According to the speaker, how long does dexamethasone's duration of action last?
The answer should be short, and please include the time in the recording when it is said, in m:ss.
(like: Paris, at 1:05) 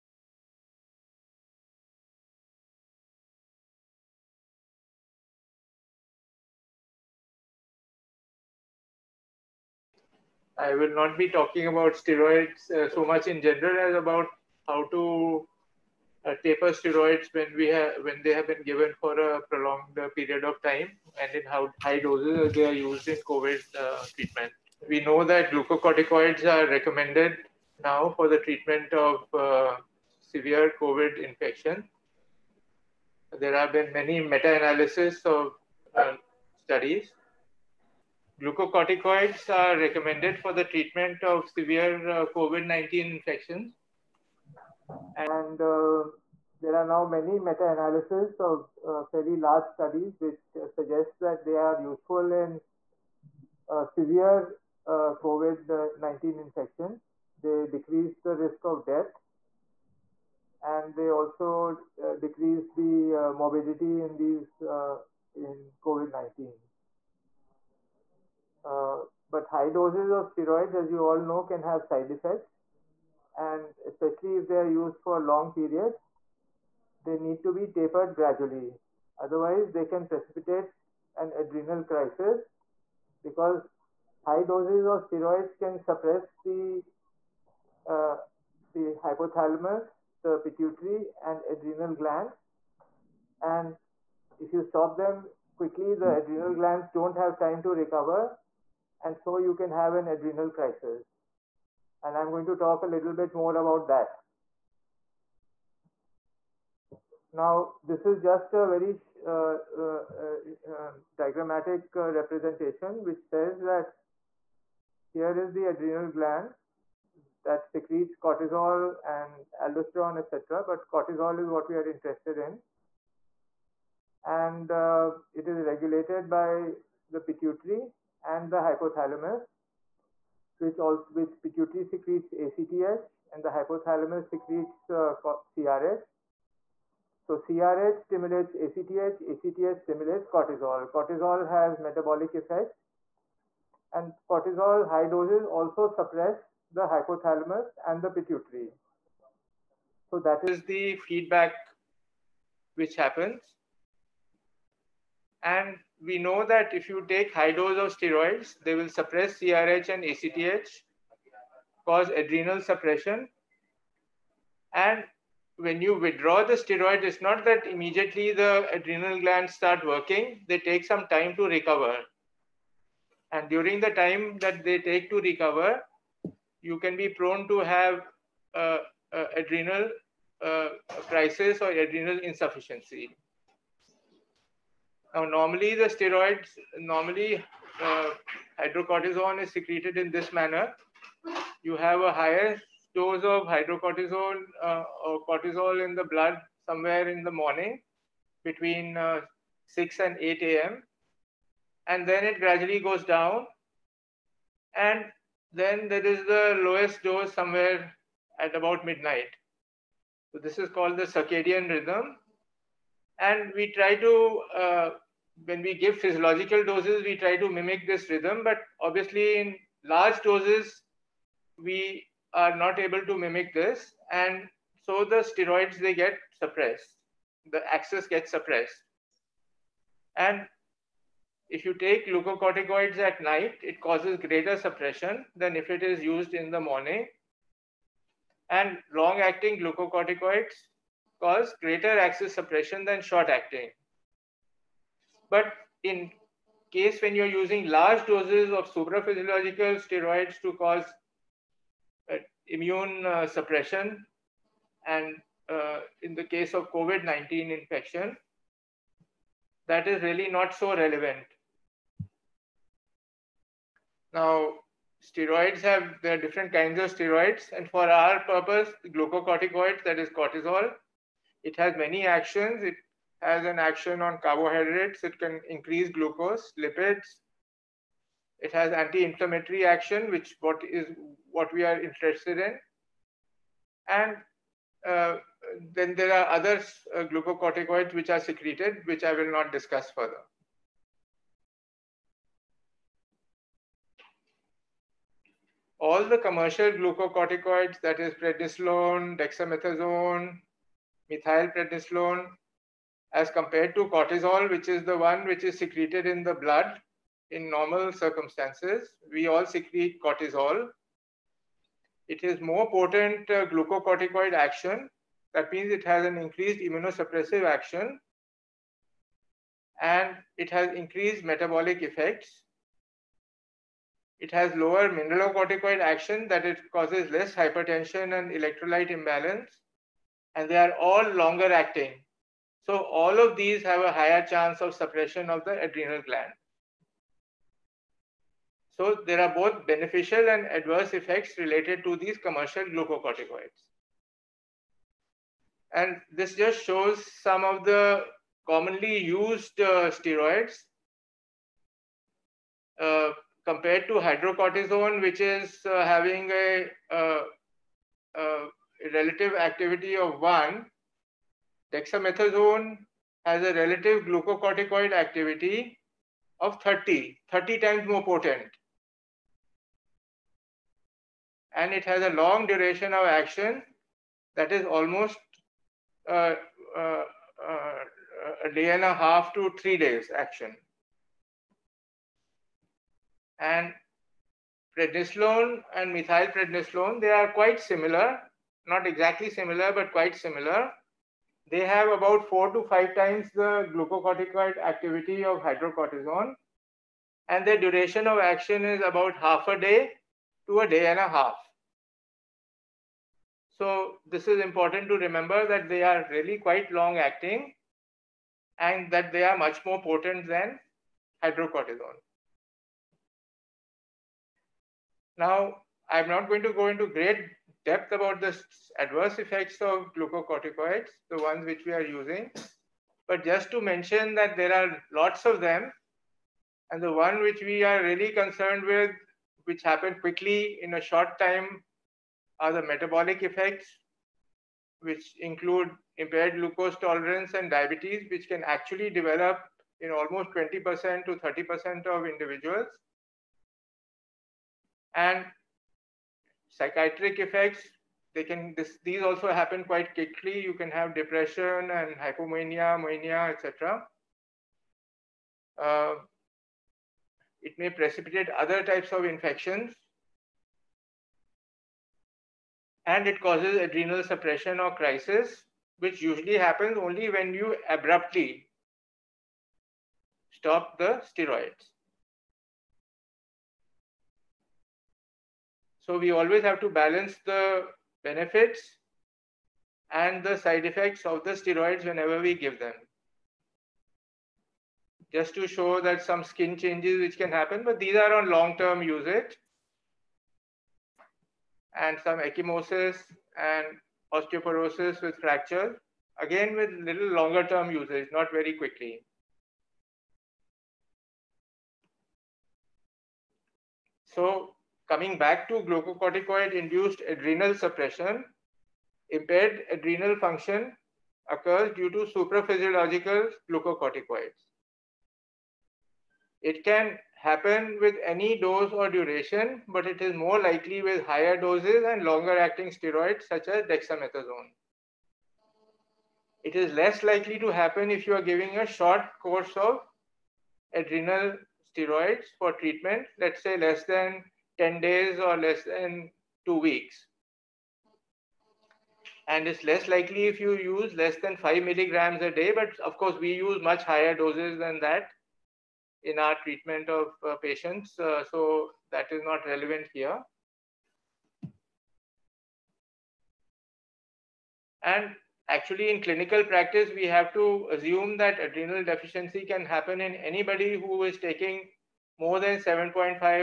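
a day and a half to three days, at 6:18.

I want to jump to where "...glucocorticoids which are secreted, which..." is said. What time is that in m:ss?
4:47.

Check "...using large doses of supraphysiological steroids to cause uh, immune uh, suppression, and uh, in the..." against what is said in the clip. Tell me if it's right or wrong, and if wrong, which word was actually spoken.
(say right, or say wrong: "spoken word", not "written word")
right.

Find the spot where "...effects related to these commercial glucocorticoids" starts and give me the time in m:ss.
5:40.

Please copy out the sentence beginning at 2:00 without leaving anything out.
But cortisol is what we are interested in.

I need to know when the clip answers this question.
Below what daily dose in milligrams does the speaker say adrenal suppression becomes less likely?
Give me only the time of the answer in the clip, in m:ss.
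9:01.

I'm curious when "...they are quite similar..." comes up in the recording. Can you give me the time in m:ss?
6:27.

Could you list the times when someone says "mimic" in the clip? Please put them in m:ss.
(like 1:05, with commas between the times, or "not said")
3:37, 3:43.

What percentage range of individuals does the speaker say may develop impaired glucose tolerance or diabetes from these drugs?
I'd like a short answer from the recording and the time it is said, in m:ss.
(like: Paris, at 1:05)
20% to 30%, at 7:20.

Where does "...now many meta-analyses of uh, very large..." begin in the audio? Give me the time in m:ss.
0:46.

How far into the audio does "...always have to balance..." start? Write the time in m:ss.
7:56.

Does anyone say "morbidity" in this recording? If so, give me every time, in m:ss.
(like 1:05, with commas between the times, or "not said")
1:03.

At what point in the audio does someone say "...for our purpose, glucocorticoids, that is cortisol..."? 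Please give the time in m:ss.
4:27.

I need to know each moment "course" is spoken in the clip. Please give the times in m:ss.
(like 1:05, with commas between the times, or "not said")
8:49, 9:02.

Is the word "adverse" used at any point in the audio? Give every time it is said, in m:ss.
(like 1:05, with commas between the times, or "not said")
5:40, 6:58.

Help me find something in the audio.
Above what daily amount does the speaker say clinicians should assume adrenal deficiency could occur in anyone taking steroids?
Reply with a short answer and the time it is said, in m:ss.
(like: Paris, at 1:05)
7.5, at 9:22.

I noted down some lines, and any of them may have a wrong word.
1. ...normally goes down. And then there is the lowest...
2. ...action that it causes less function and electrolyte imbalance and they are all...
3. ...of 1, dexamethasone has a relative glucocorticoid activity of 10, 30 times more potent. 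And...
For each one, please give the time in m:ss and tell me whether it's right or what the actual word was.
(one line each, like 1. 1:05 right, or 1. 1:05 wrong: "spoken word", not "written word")
1. 3:22 wrong: "gradually", not "normally"
2. 5:25 wrong: "hypertension", not "function"
3. 5:59 wrong: "30", not "10".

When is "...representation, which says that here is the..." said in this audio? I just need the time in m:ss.
1:52.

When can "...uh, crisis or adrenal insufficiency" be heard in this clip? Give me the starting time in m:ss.
3:00.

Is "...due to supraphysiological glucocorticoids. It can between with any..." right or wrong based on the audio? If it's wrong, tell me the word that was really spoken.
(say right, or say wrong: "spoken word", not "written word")
wrong: "happen", not "between".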